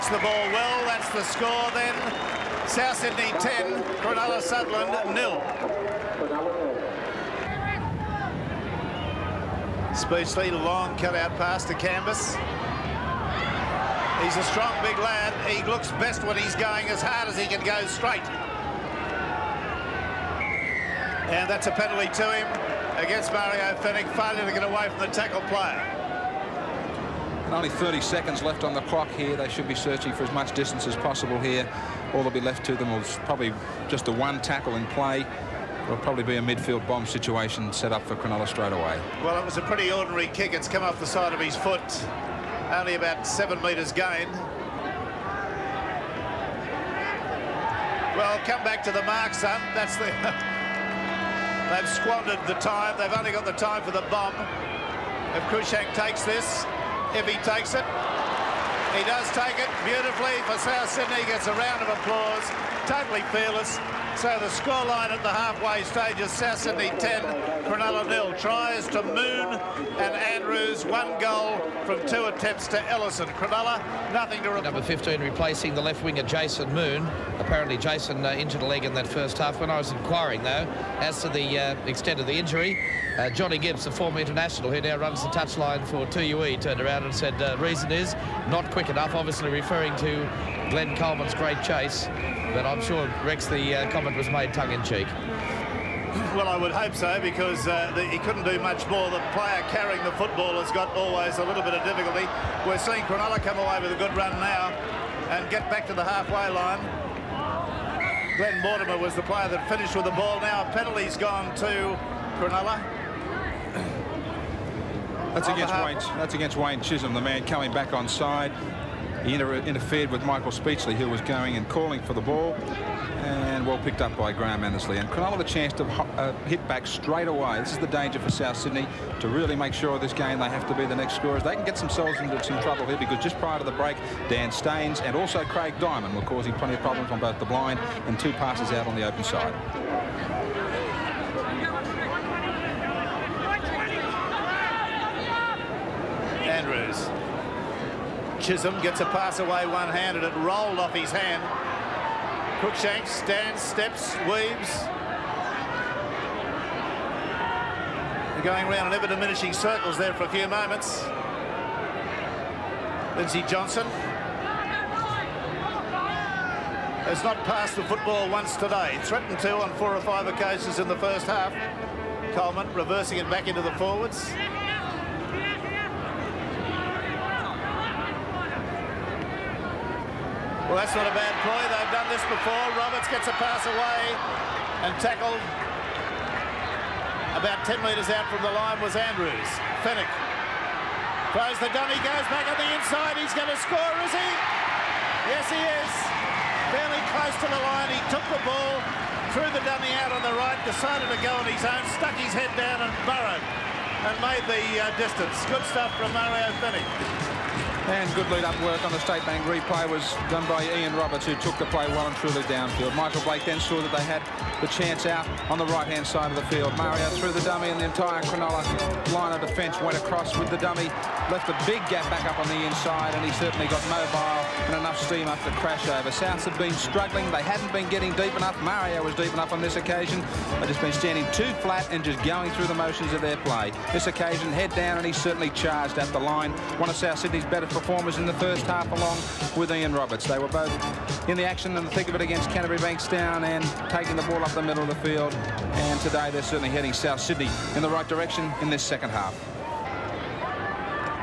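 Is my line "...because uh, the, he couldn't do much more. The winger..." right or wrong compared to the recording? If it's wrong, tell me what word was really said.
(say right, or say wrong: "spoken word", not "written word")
wrong: "player", not "winger".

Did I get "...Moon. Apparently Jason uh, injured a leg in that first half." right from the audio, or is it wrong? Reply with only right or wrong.
right.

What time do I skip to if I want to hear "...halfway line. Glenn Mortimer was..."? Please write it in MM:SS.
01:46.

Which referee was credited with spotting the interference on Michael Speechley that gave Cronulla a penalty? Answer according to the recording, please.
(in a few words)
Graham Annesley.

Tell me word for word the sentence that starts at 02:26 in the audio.
Andrews Chisholm gets a pass away one-handed.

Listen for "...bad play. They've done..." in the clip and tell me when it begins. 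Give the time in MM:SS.
03:01.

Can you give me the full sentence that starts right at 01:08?
Tries to Moon and Andrews, one goal from two attempts to Ellison.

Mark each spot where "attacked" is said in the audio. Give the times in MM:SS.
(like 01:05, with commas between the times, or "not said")
not said.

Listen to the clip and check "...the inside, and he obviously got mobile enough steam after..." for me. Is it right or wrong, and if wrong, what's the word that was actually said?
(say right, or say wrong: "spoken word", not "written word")
wrong: "certainly", not "obviously".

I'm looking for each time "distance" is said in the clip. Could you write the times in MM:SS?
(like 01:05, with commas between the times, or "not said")
00:30, 03:25.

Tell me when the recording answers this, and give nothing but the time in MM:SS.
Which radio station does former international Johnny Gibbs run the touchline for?
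01:26.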